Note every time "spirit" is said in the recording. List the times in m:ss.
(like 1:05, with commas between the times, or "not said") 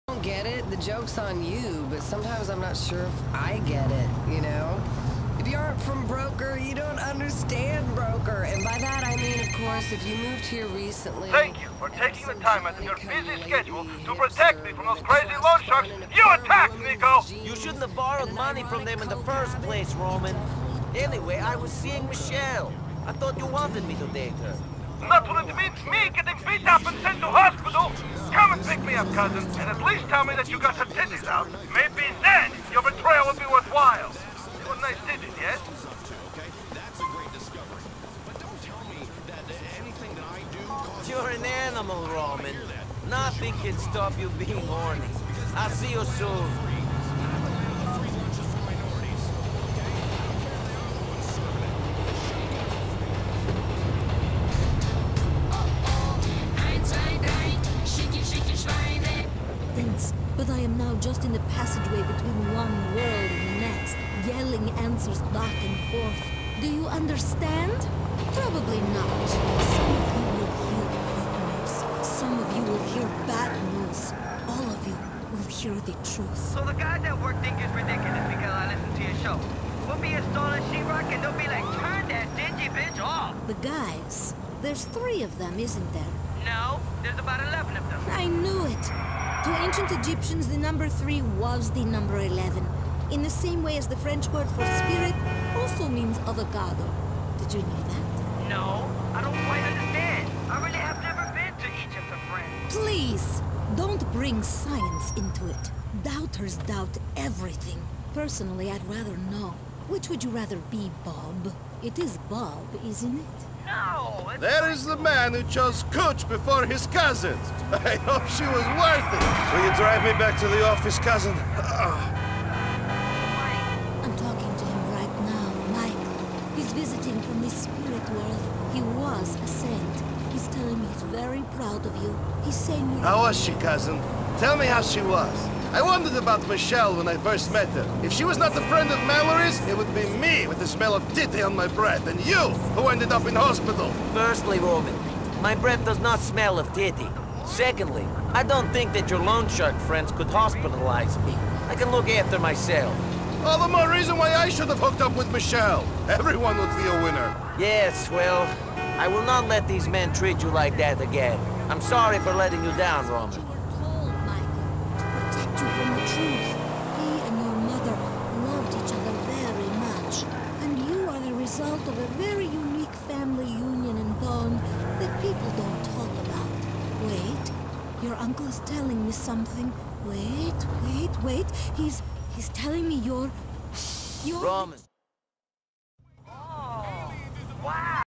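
1:34, 2:07.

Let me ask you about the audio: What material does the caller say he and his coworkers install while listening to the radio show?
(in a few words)
Sheetrock.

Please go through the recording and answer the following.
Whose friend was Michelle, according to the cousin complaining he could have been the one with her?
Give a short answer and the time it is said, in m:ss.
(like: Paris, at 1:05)
Mallory, at 2:19.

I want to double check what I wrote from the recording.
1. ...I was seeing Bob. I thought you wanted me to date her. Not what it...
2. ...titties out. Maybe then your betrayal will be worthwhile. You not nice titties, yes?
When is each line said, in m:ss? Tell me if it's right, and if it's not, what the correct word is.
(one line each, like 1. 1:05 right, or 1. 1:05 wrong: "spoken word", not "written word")
1. 0:21 wrong: "Michelle", not "Bob"
2. 0:30 right.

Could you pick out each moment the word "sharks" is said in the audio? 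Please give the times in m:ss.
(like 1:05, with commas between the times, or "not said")
0:15, 2:29.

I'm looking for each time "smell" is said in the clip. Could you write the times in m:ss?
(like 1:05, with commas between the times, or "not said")
2:20, 2:26.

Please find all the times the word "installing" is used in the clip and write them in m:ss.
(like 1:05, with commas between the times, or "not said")
1:20.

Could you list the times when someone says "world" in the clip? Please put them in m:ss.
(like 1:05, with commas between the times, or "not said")
1:02, 2:08.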